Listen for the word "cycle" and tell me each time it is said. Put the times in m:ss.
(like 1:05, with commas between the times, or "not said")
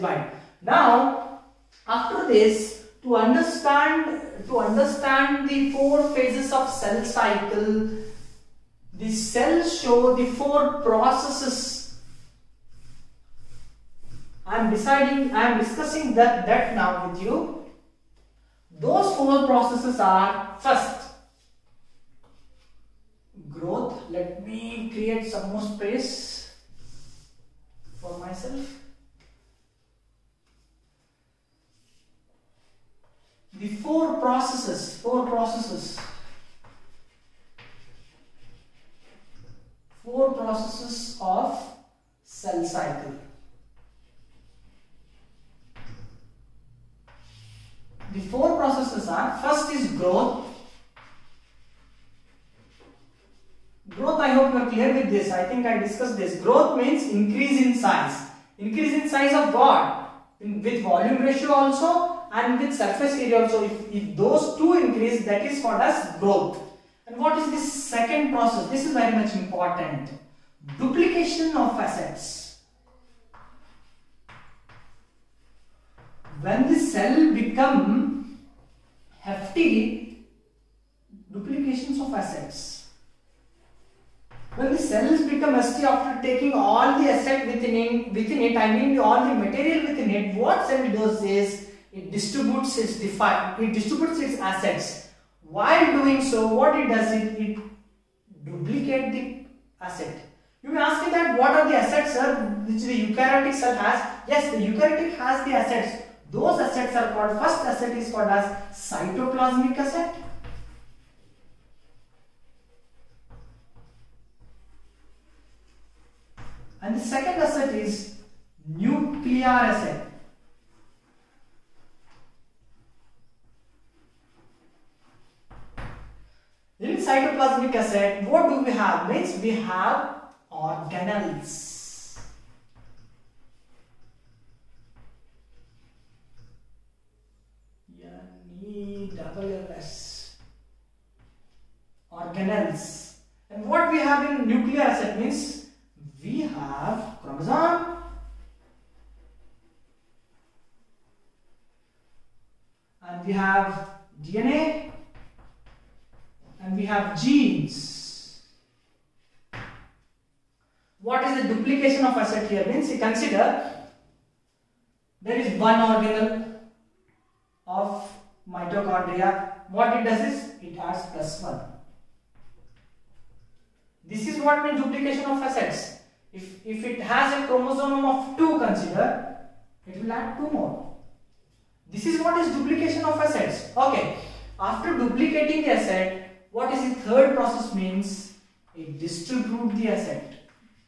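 0:07, 0:42.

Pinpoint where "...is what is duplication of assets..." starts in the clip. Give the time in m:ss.
3:02.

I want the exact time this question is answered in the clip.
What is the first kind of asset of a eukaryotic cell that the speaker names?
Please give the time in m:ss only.
1:48.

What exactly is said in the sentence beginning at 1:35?
While doing so, what it does is it duplicate the asset.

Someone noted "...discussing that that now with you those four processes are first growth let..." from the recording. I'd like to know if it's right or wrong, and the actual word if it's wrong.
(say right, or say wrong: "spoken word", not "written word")
right.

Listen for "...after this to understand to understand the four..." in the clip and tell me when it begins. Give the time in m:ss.
0:01.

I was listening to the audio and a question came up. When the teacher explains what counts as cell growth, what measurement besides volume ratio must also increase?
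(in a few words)
Surface area.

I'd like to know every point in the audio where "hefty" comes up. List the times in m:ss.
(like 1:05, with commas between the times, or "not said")
1:19, 1:25.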